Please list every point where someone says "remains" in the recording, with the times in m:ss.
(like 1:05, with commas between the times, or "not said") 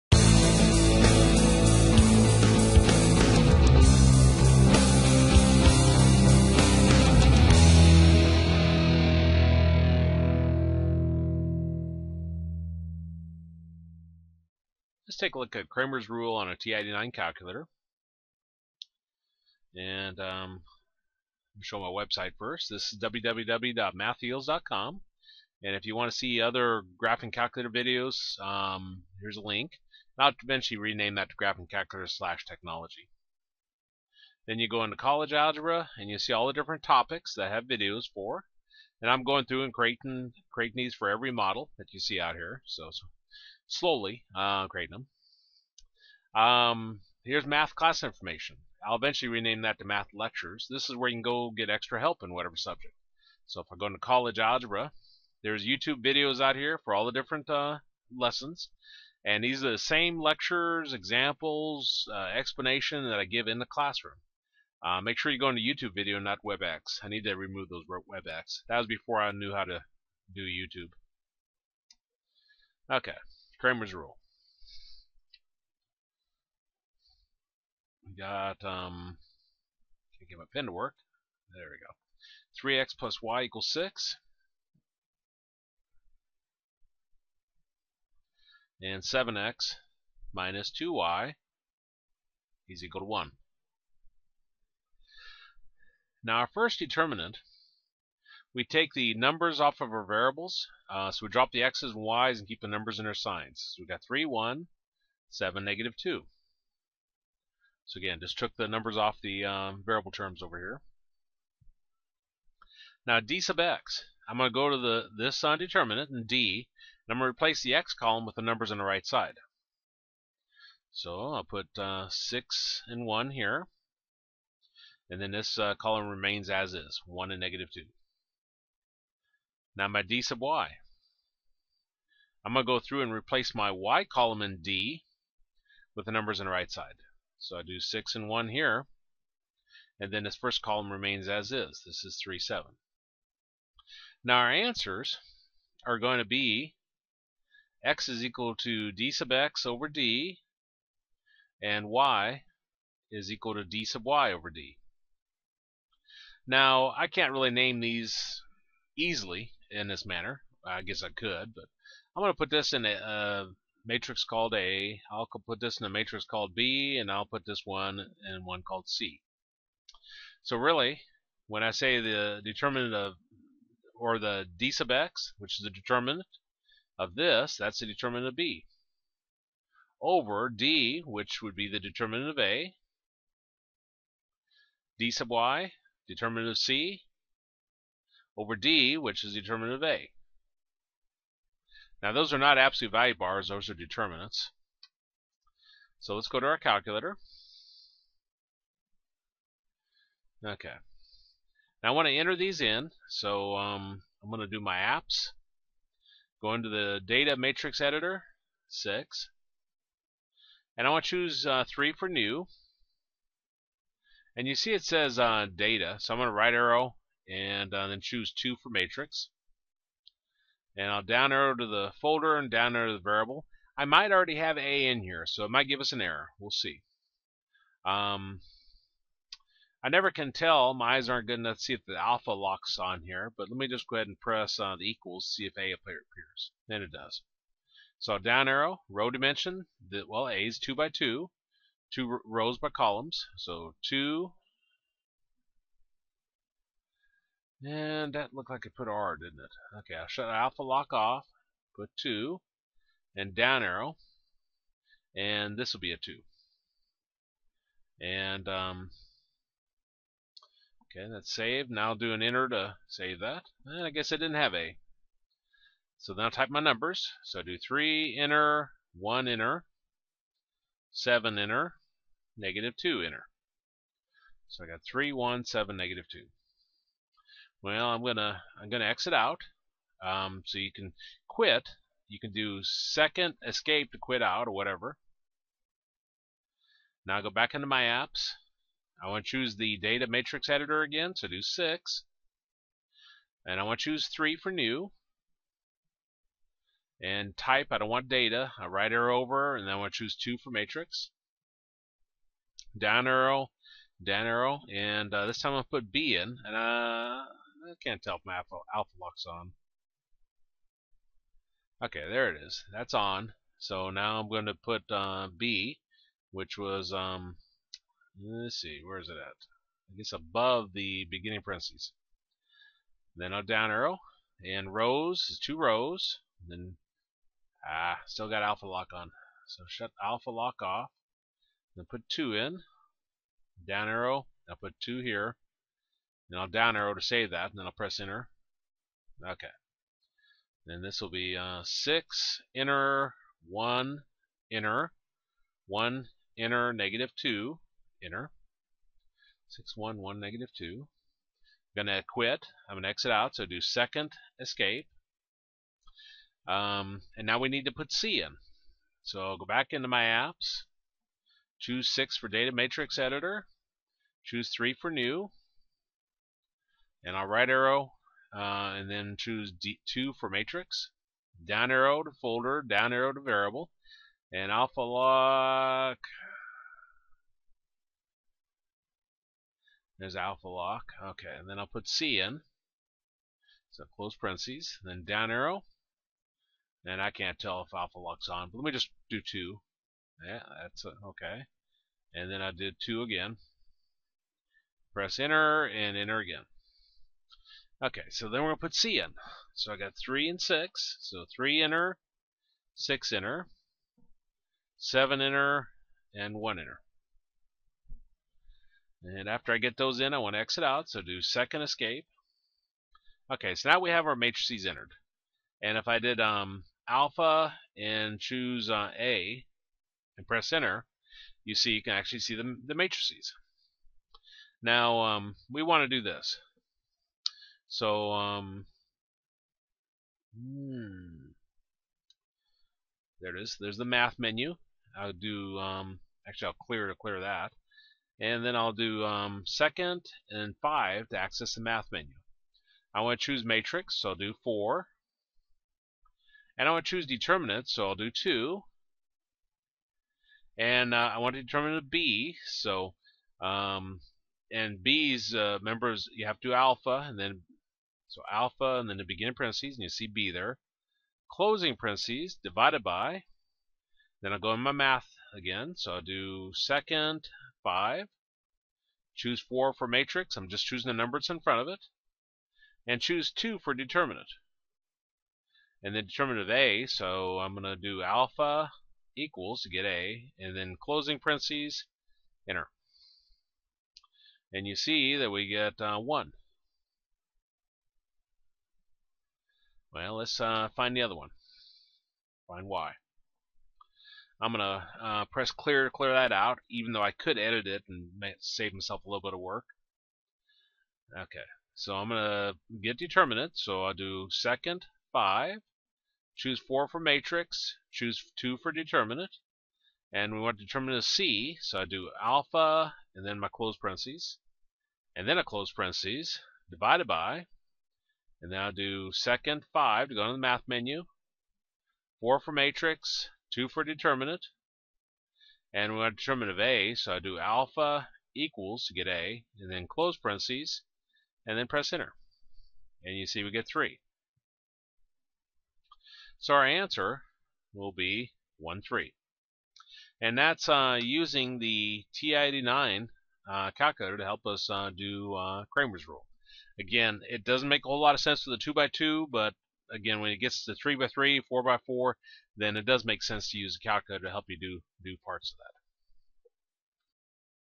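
2:06, 2:20.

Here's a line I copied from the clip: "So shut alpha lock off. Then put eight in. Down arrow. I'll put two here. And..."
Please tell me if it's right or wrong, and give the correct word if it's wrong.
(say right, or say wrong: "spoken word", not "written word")
wrong: "two", not "eight".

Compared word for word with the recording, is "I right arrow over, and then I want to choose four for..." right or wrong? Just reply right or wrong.
wrong.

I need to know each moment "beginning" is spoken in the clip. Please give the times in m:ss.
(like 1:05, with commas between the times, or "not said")
5:21, 7:39.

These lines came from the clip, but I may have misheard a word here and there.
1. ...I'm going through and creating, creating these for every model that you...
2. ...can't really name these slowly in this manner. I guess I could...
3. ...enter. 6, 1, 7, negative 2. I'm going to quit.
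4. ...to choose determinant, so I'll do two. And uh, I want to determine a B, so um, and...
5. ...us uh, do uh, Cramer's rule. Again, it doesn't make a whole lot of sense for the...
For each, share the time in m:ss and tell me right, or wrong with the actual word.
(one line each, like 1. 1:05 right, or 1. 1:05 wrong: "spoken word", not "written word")
1. 0:39 right
2. 2:37 wrong: "easily", not "slowly"
3. 5:48 wrong: "1", not "7"
4. 7:26 right
5. 9:04 right.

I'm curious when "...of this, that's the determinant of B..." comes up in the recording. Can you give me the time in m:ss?
2:56.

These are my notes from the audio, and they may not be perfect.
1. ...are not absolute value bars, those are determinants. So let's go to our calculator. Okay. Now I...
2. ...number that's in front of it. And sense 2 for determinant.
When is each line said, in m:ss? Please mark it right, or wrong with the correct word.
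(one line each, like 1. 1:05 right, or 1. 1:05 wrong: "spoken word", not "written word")
1. 3:12 right
2. 7:50 wrong: "choose", not "sense".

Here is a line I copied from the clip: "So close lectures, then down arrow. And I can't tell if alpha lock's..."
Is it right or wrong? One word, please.
wrong.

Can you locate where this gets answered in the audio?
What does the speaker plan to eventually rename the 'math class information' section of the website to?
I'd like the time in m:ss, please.
0:49.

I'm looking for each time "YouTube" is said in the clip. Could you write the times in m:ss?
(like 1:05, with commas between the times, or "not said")
0:55, 1:05, 1:10.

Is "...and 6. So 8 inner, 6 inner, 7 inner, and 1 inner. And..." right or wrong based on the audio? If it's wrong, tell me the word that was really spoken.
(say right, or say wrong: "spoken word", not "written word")
wrong: "3", not "8".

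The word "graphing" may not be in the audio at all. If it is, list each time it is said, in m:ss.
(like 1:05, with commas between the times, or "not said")
0:27, 0:31.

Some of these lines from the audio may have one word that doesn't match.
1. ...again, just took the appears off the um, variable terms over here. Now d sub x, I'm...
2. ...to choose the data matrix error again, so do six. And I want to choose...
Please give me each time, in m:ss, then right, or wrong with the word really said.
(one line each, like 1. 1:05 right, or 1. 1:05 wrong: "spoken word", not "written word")
1. 1:47 wrong: "numbers", not "appears"
2. 4:49 wrong: "editor", not "error".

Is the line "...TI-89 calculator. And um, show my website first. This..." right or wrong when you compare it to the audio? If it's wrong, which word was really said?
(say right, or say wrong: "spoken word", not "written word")
right.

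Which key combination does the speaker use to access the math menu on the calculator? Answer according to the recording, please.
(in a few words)
second and 5.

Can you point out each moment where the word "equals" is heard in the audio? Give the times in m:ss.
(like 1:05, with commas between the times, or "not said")
1:23, 1:32, 2:28, 2:33, 3:54, 7:59, 8:48.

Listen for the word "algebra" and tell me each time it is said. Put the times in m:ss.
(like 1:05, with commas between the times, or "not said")
0:35, 0:54.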